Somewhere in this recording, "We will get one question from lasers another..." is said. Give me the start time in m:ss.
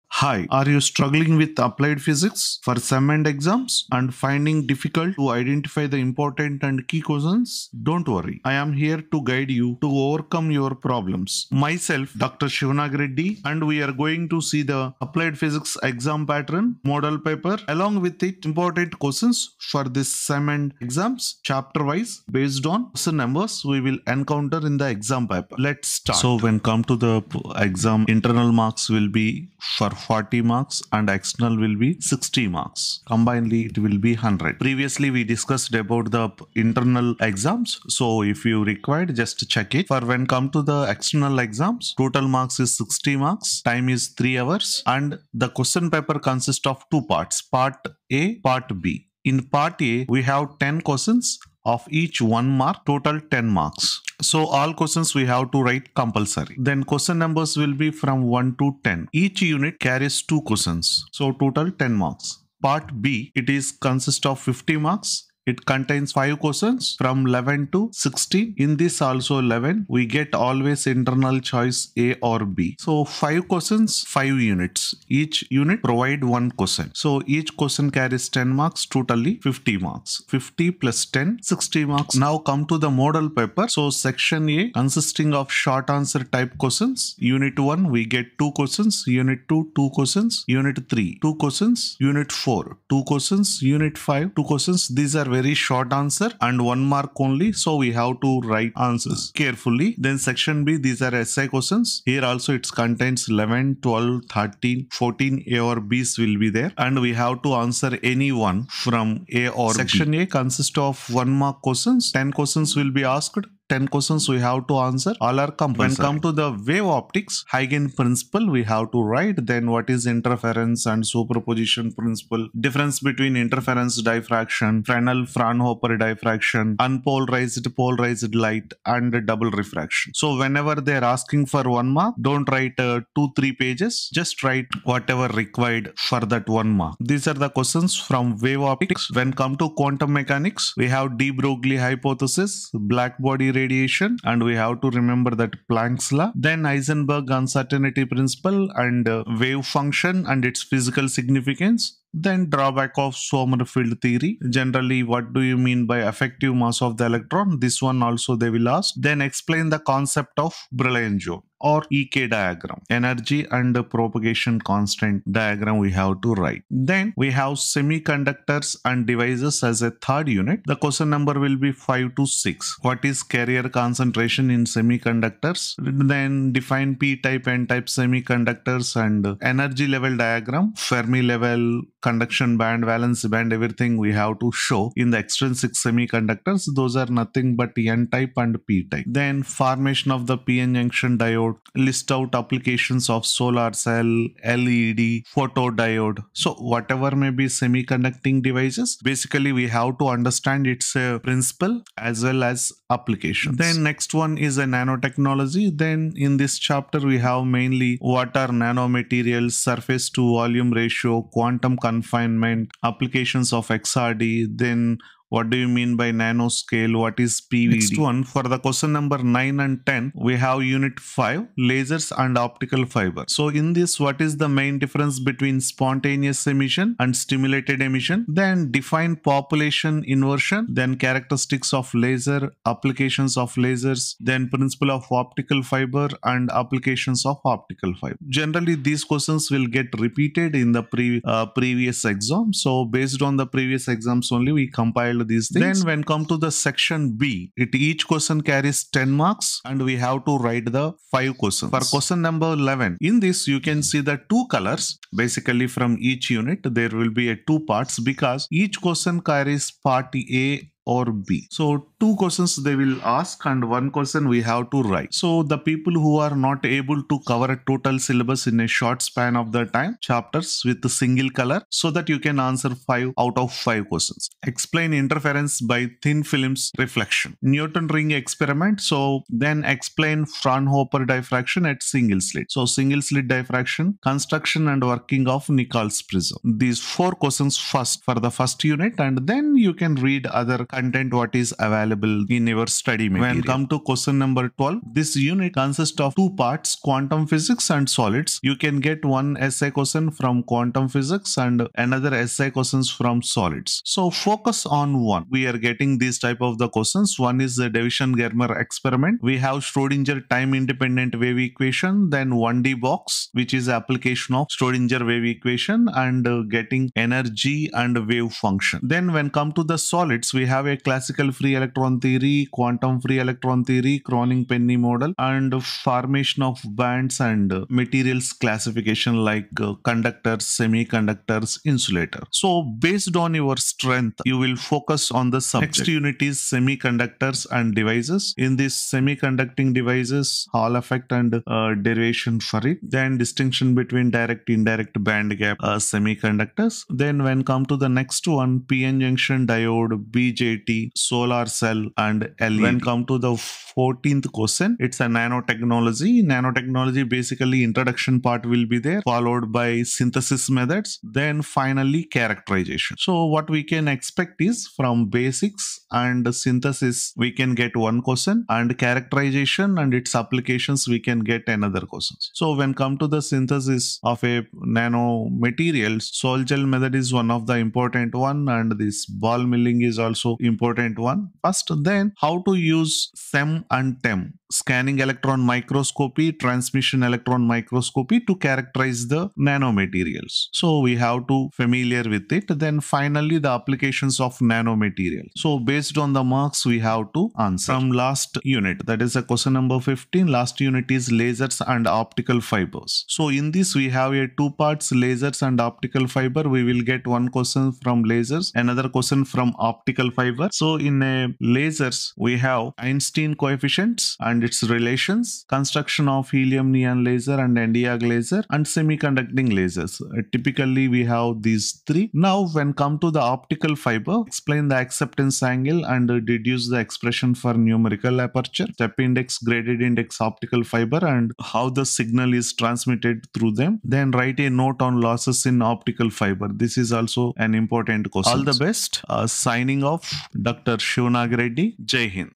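6:46.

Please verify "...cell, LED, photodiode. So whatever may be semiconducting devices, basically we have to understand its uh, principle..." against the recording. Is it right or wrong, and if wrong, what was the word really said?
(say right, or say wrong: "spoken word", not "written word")
right.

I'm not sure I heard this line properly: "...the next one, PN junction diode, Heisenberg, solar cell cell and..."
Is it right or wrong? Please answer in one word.
wrong.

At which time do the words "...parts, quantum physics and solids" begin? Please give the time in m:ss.
4:56.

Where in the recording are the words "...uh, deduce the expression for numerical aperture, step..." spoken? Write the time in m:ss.
7:06.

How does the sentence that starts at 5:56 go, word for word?
Nanotechnology basically introduction part will be there, followed by synthesis methods, then finally characterization.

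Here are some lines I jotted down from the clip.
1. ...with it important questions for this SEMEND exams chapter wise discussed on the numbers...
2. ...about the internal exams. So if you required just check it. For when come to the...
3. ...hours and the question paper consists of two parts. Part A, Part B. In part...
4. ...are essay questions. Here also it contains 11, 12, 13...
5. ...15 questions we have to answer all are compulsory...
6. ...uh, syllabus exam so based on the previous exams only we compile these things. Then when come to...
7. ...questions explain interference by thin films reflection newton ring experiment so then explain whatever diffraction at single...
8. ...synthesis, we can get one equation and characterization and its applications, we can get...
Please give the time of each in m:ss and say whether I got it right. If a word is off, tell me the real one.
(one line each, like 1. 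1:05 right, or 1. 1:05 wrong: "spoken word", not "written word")
1. 0:18 wrong: "based", not "discussed"
2. 0:35 right
3. 0:44 right
4. 1:41 right
5. 1:53 wrong: "10", not "15"
6. 4:01 wrong: "previous", not "syllabus"
7. 4:33 wrong: "fraunhofer", not "whatever"
8. 6:06 wrong: "question", not "equation".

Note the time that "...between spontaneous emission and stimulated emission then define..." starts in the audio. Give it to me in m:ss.
3:45.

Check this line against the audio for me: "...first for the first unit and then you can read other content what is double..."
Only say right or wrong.
wrong.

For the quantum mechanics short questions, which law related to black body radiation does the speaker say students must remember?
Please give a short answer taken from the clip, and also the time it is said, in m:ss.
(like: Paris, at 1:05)
Planck's law, at 2:25.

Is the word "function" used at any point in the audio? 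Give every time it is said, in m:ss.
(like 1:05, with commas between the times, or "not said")
2:29, 5:18.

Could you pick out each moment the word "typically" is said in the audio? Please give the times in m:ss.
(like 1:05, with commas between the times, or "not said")
7:00.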